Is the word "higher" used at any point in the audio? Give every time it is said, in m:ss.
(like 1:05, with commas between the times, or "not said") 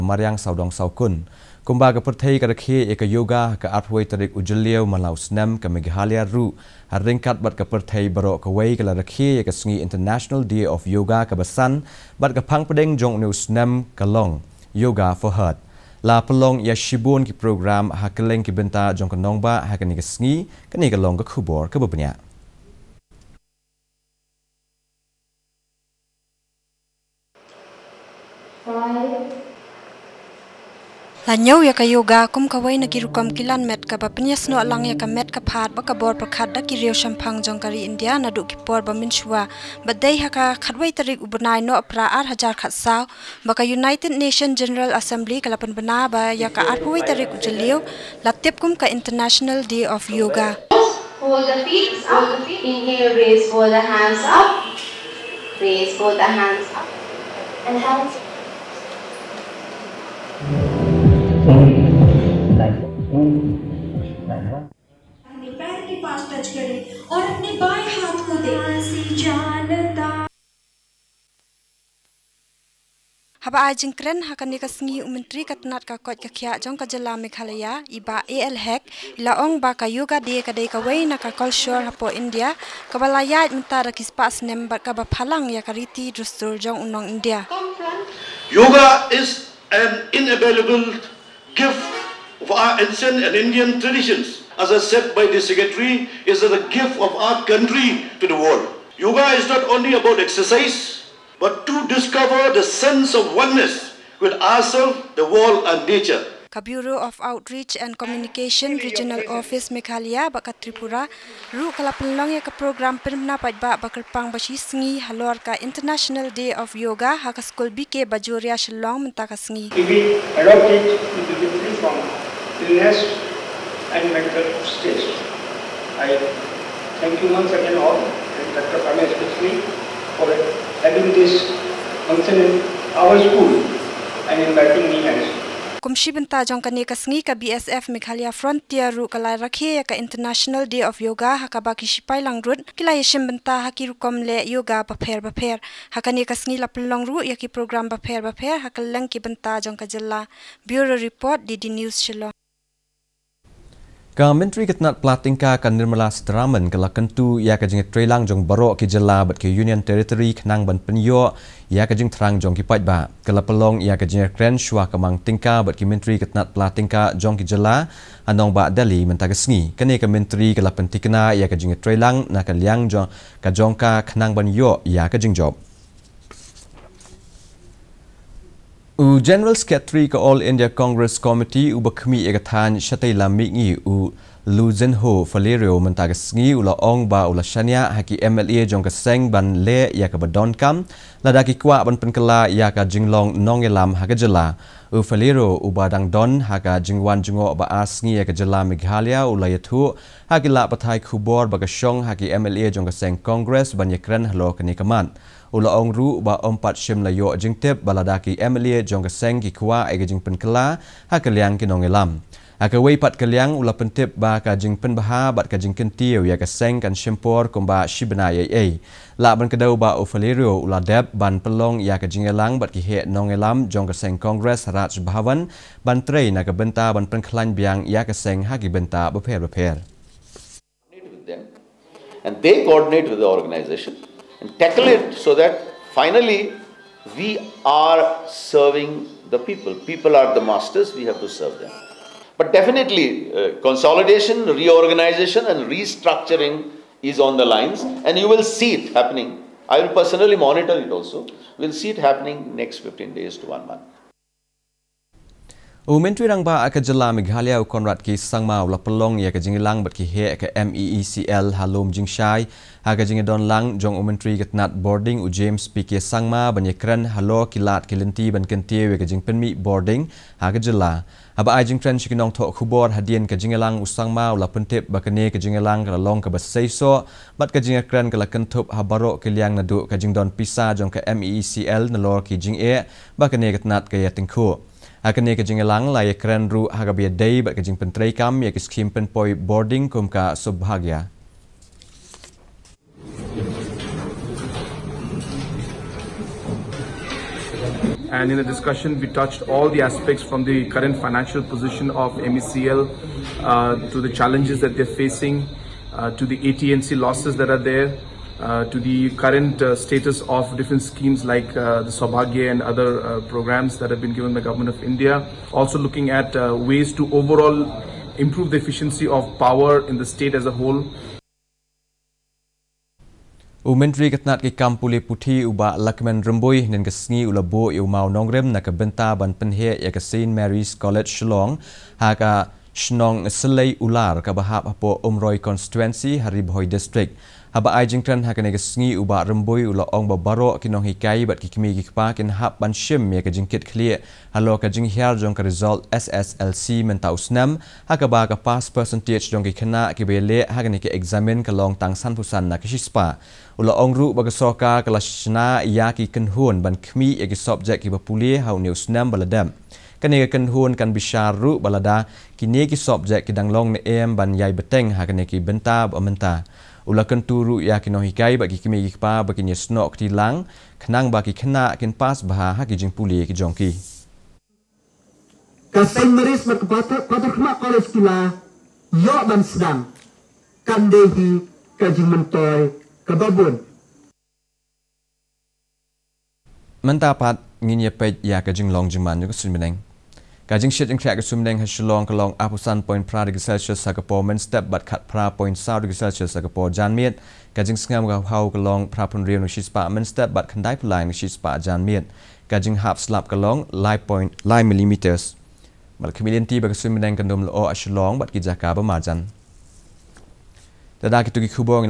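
not said.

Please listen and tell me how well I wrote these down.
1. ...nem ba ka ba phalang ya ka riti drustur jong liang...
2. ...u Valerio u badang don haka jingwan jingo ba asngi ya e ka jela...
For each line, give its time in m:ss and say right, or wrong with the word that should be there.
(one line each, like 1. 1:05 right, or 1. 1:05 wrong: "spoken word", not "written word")
1. 1:24 wrong: "unong", not "liang"
2. 3:14 right.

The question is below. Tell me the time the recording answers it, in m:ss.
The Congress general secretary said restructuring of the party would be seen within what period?
4:12.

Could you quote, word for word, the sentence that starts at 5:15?
Also looking at ways to overall improve the efficiency of power in the state as a whole.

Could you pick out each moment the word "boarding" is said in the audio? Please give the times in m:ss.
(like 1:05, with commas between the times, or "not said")
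4:24, 4:29, 4:49.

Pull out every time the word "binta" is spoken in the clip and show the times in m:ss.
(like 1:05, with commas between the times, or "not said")
2:16, 2:23, 2:29.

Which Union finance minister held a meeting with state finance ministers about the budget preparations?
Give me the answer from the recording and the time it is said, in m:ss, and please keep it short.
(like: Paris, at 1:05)
Nirmala Sitaraman, at 2:35.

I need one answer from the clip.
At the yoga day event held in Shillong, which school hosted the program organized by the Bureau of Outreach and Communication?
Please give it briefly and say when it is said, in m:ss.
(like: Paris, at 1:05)
BK Bajoria, at 1:57.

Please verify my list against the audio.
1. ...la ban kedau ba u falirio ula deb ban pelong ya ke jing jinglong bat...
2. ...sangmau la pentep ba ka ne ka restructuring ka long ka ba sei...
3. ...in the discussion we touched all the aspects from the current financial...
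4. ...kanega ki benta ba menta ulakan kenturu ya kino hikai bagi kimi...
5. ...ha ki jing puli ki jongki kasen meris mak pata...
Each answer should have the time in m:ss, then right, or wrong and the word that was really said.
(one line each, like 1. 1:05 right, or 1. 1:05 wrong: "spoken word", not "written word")
1. 3:39 wrong: "elang", not "jinglong"
2. 4:33 wrong: "jingilang", not "restructuring"
3. 4:58 right
4. 6:05 right
5. 6:12 right.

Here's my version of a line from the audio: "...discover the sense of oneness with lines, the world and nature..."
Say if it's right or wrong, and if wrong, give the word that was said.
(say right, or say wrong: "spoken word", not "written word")
wrong: "ourselves", not "lines".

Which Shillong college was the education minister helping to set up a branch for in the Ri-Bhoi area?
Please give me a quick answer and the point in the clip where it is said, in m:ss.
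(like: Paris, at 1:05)
St Mary's College, at 5:29.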